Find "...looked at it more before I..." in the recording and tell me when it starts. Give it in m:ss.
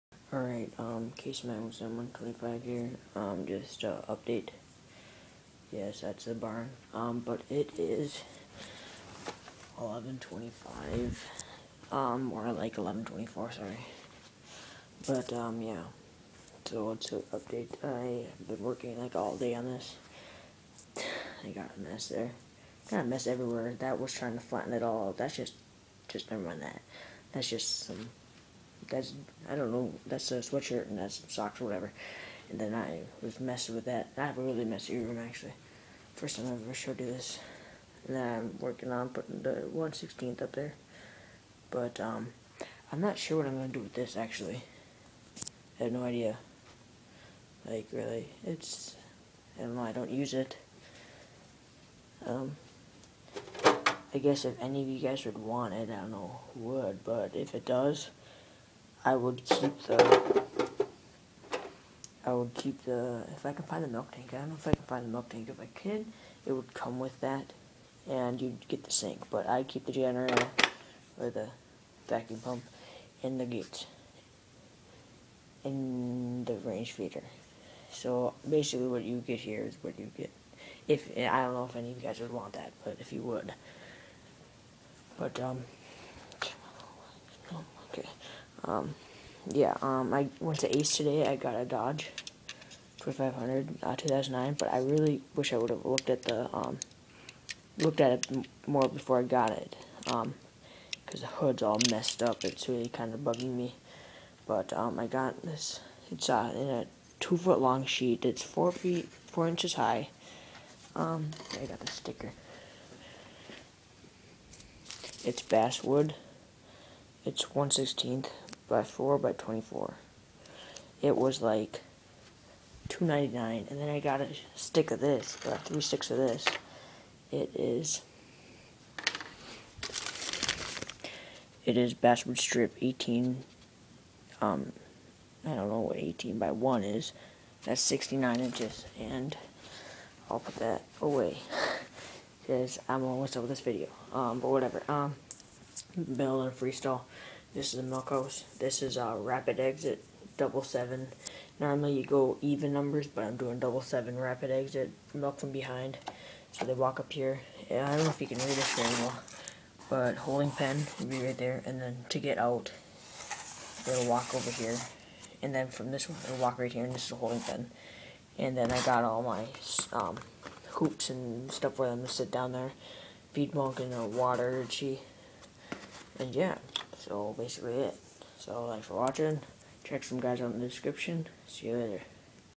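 1:37.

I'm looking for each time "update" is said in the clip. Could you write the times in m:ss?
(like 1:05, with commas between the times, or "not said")
0:04, 0:17.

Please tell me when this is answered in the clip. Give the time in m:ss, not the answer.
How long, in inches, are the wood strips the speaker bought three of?
2:17.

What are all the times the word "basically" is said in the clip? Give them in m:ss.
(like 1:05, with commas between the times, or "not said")
1:18, 2:57.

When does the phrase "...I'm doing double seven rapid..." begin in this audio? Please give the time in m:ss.
2:33.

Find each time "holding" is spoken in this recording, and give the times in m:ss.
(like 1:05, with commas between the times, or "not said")
2:40, 2:47.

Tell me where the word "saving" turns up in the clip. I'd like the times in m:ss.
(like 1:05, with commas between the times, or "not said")
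not said.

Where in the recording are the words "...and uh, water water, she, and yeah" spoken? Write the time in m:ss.
2:53.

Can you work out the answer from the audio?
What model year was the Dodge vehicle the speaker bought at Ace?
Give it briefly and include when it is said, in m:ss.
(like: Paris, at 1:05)
2009, at 1:33.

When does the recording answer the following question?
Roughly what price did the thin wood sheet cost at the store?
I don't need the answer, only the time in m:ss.
2:02.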